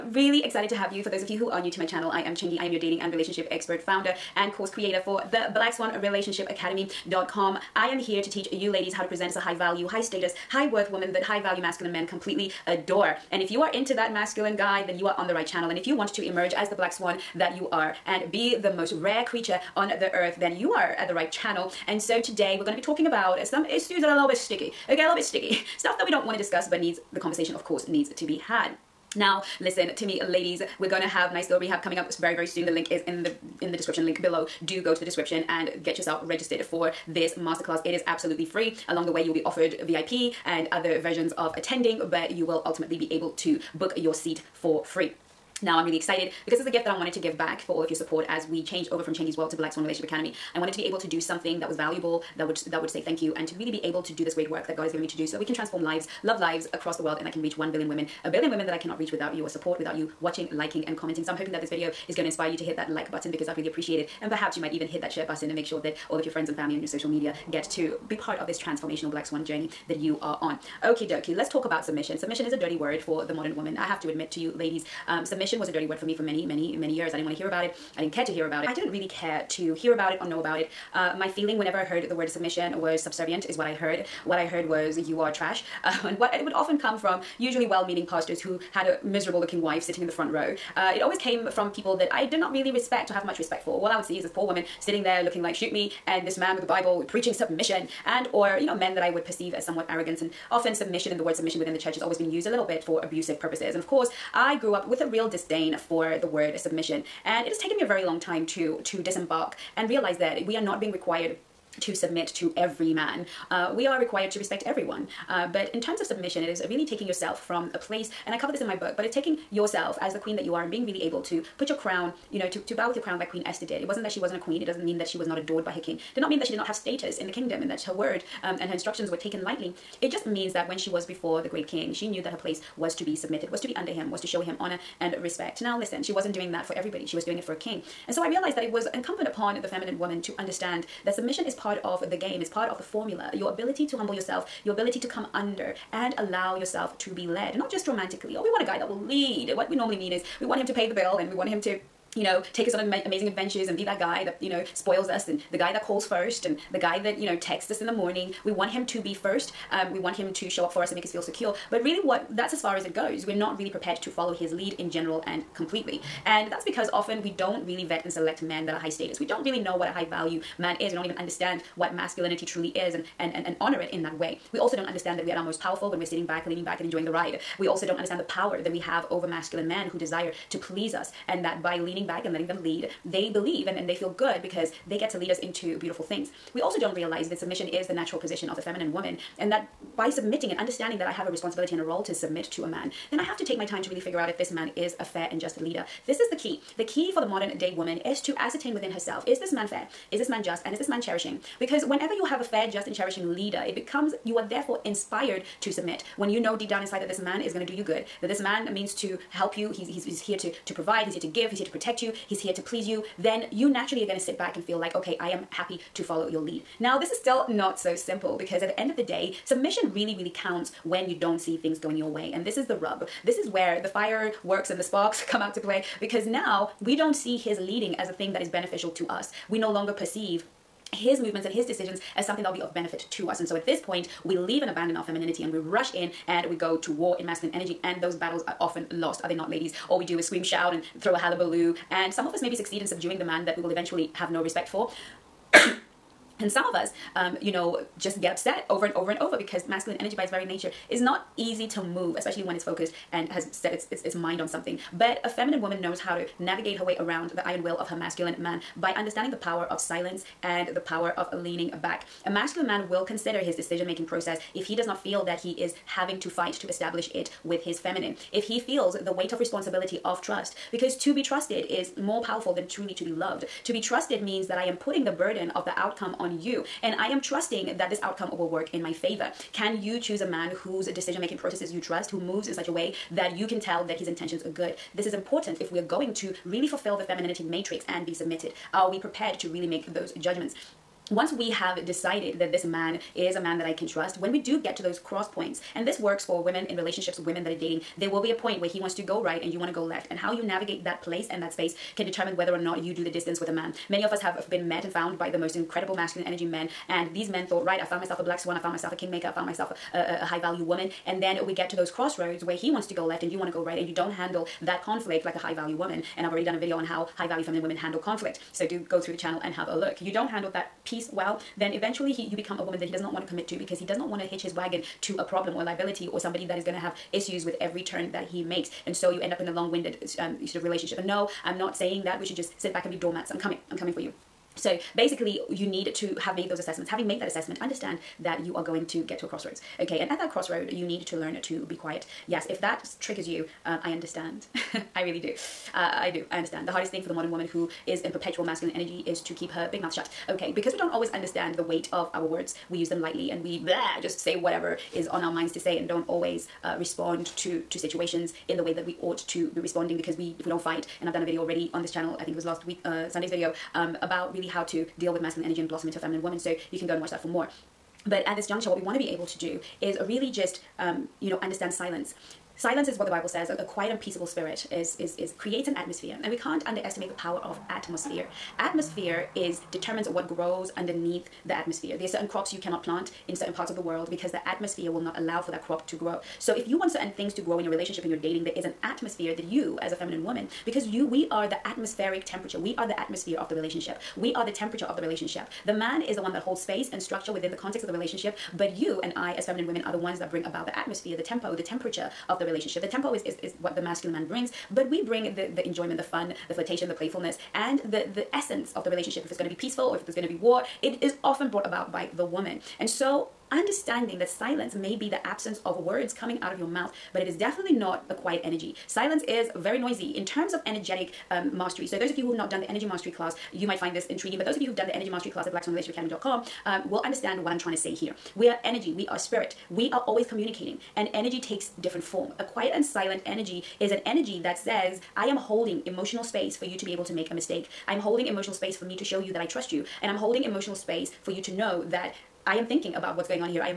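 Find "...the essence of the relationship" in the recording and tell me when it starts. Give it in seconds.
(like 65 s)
408 s.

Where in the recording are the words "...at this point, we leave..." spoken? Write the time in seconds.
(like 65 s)
233 s.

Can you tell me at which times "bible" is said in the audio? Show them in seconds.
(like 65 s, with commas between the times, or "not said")
96 s, 373 s.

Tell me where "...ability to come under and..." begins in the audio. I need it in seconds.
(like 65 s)
144 s.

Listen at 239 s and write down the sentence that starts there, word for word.
All we do is scream, shout, and throw a hallabaloo.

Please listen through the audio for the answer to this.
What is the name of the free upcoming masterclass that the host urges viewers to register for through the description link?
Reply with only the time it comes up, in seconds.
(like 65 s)
31 s.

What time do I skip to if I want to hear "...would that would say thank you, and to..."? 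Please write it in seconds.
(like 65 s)
52 s.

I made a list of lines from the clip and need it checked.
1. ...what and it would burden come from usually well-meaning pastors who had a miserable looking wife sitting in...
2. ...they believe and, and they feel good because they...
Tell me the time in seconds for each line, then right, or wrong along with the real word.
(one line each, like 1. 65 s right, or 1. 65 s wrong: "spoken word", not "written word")
1. 86 s wrong: "often", not "burden"
2. 183 s right.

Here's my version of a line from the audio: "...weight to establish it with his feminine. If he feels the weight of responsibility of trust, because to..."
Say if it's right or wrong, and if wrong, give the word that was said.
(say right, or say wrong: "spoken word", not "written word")
wrong: "fight", not "weight".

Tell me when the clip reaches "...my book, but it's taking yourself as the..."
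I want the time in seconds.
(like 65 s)
118 s.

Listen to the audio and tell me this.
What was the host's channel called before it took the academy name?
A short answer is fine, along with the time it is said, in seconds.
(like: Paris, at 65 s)
Chengi's World, at 49 s.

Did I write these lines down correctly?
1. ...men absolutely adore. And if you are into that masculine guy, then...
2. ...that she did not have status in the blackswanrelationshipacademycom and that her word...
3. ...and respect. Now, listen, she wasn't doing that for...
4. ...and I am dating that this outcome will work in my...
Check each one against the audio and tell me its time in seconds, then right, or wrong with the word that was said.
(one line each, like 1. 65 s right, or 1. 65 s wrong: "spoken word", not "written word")
1. 11 s wrong: "completely", not "absolutely"
2. 126 s wrong: "kingdom", not "blackswanrelationshipacademycom"
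3. 135 s right
4. 276 s wrong: "trusting", not "dating".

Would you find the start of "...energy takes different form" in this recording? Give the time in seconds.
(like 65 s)
431 s.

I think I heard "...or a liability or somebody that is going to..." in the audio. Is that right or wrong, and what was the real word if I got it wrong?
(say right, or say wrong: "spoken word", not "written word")
right.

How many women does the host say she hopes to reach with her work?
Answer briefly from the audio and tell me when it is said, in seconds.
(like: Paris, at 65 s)
1 billion, at 57 s.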